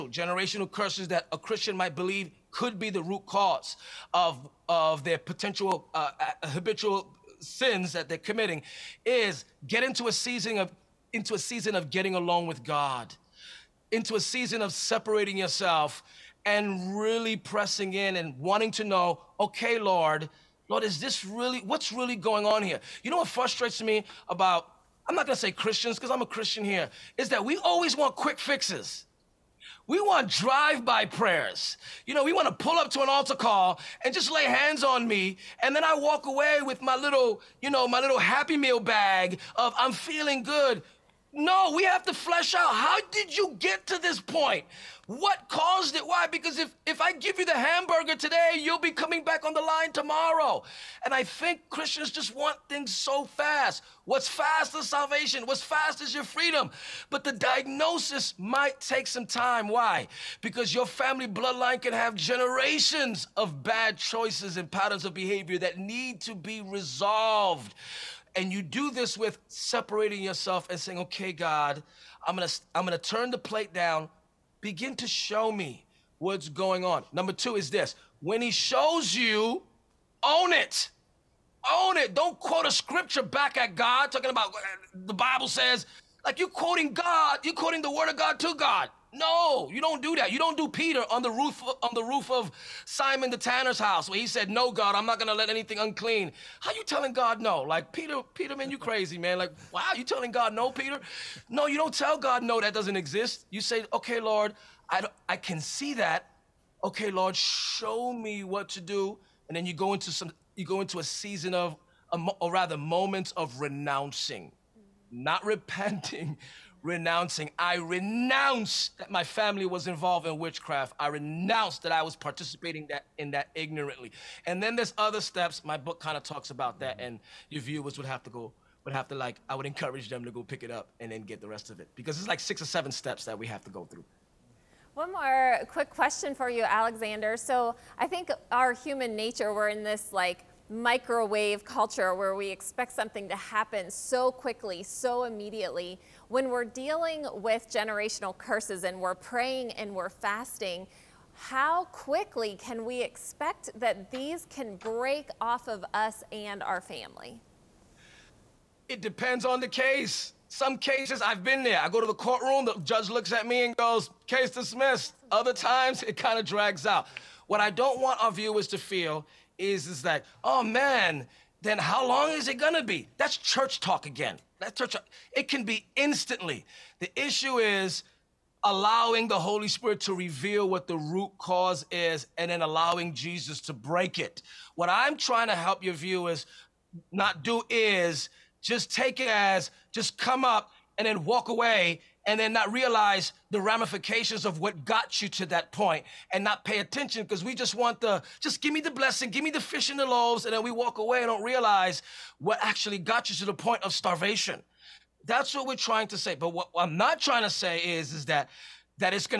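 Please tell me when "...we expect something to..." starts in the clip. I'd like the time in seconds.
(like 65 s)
142 s.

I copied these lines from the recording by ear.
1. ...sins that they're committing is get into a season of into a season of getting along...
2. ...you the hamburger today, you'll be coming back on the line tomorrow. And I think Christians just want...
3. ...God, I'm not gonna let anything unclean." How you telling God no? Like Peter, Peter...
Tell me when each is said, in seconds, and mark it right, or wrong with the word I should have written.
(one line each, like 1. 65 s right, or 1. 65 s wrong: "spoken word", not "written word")
1. 7 s right
2. 47 s right
3. 94 s right.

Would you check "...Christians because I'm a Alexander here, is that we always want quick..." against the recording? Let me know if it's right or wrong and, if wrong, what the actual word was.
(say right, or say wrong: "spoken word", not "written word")
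wrong: "Christian", not "Alexander".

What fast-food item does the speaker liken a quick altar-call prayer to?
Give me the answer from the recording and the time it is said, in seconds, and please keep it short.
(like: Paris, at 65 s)
Happy Meal bag, at 38 s.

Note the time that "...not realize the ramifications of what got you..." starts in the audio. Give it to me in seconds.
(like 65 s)
192 s.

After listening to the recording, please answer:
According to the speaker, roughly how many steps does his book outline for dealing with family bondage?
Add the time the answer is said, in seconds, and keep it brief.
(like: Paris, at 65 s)
6 or 7, at 132 s.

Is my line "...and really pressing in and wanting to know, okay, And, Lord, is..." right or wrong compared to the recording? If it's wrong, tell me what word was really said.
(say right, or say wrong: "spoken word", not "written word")
wrong: "Lord", not "And".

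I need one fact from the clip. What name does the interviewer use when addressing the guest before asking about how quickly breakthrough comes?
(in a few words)
Alexander.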